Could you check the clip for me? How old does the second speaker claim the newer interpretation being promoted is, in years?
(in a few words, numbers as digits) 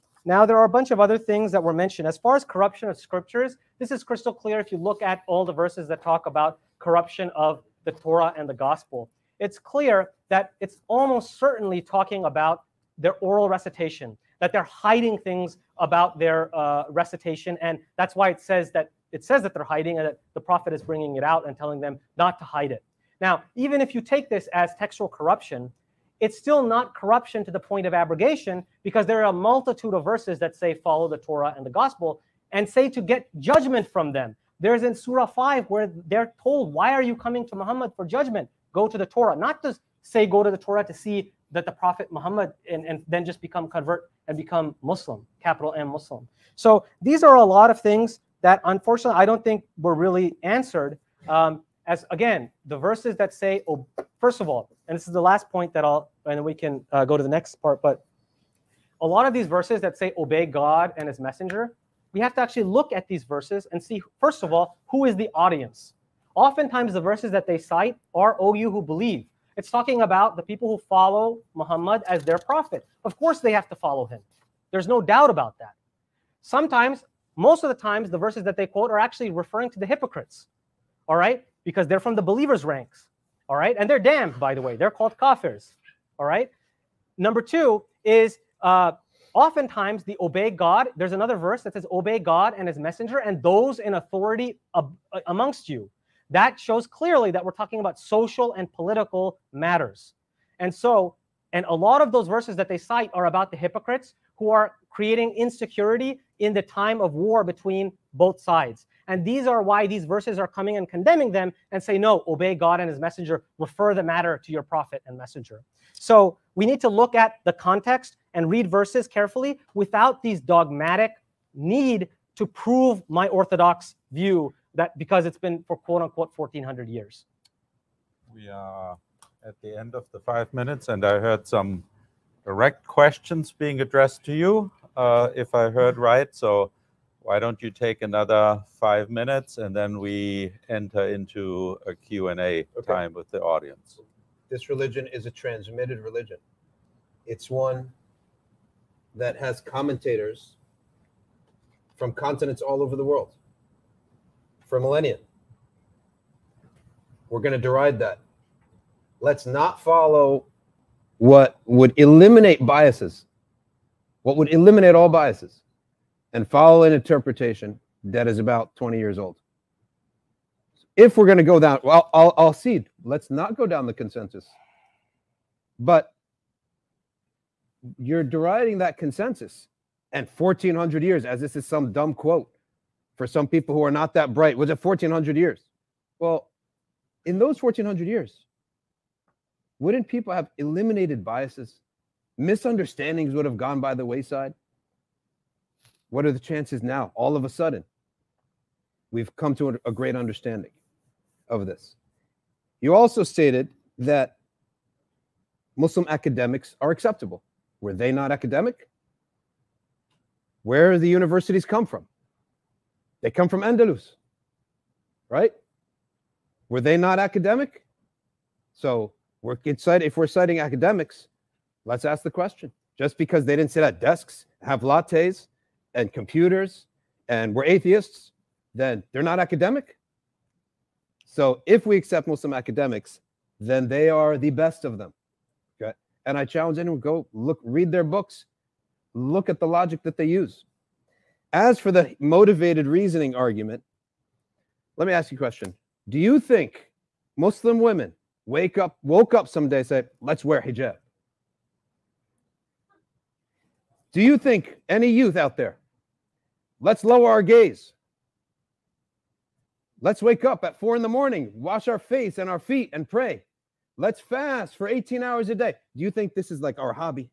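20 years.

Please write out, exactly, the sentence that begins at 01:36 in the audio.
That shows clearly that we're talking about social and political matters.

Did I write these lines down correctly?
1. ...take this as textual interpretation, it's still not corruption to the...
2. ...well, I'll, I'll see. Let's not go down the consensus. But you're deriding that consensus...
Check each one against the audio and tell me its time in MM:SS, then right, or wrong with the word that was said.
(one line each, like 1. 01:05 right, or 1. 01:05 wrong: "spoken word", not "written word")
1. 00:24 wrong: "corruption", not "interpretation"
2. 02:51 right.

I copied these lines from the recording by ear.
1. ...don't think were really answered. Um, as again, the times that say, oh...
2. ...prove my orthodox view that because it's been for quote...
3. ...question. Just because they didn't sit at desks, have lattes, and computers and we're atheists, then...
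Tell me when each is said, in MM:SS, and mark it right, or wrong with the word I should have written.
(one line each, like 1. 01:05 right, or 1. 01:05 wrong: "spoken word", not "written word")
1. 00:49 wrong: "verses", not "times"
2. 02:02 right
3. 03:42 right.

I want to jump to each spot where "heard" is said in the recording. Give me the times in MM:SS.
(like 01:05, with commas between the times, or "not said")
02:11, 02:15.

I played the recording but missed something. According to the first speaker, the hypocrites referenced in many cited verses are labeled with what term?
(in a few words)
kafirs.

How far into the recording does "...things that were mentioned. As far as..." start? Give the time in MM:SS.
00:01.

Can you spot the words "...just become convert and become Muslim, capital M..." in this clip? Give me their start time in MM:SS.
00:43.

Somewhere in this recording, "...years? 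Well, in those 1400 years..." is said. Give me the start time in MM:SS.
03:05.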